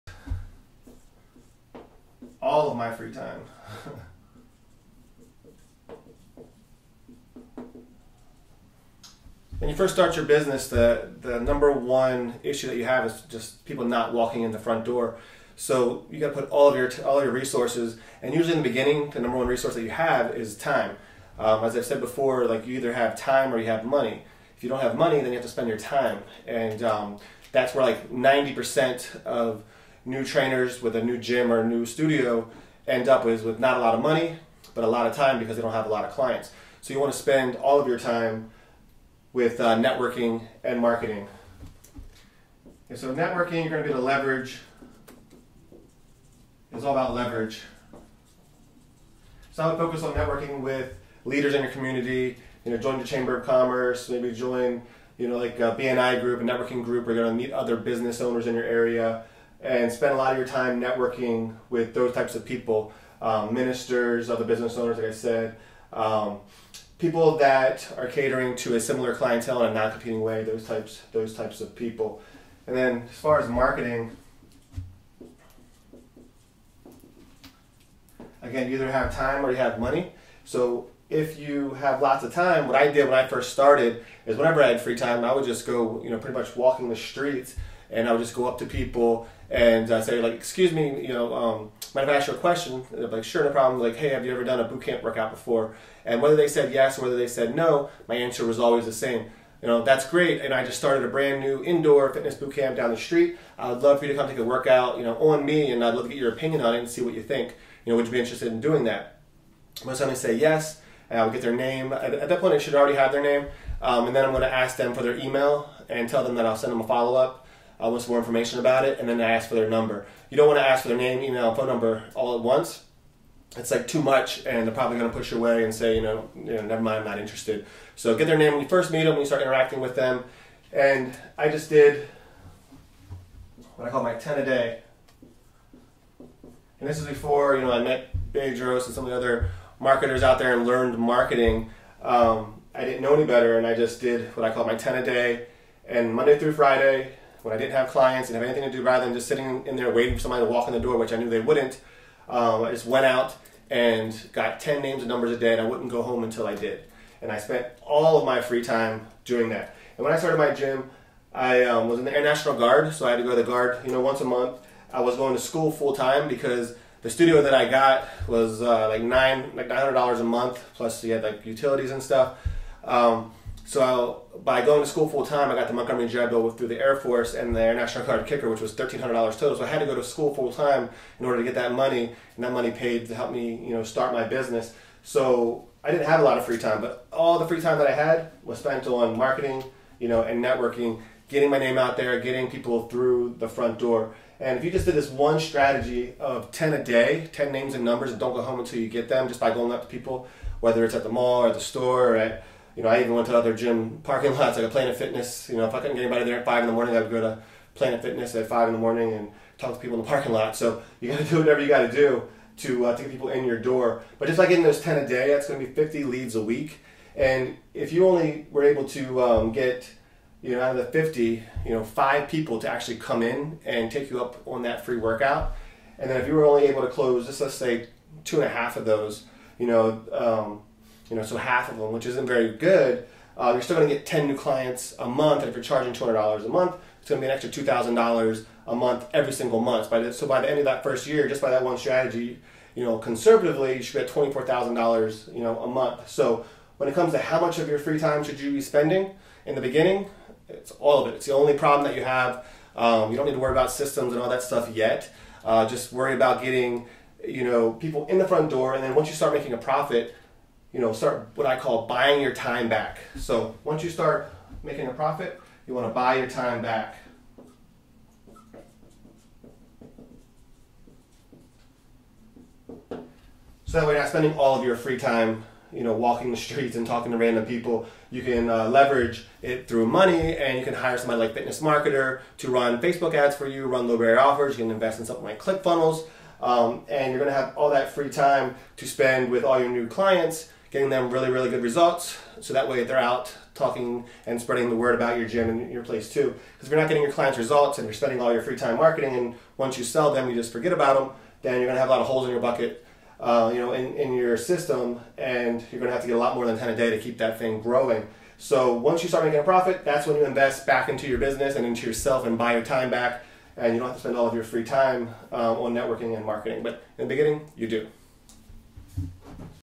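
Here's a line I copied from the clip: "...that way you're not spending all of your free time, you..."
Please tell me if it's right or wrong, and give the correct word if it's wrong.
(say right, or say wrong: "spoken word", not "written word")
right.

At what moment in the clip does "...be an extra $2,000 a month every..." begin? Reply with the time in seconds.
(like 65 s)
237 s.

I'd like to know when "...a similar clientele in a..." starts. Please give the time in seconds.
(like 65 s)
68 s.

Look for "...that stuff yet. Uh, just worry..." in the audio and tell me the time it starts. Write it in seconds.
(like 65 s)
254 s.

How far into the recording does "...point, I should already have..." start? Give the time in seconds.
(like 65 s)
112 s.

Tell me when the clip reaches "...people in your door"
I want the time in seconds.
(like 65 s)
213 s.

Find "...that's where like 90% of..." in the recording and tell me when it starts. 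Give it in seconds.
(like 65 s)
27 s.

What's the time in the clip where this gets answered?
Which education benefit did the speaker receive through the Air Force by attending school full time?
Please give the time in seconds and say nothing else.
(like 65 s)
175 s.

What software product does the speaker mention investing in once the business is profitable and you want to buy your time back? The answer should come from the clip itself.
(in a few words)
ClickFunnels.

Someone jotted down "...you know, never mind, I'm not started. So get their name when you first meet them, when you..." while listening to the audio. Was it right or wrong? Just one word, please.
wrong.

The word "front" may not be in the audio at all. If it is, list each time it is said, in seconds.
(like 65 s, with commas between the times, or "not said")
14 s, 193 s, 258 s.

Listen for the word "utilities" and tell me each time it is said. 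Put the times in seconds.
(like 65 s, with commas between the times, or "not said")
171 s.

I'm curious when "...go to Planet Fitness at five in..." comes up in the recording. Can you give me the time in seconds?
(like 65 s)
207 s.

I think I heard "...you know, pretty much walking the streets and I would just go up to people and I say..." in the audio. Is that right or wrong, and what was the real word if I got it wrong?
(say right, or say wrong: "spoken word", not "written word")
right.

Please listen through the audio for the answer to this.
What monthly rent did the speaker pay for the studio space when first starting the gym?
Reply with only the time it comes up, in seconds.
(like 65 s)
169 s.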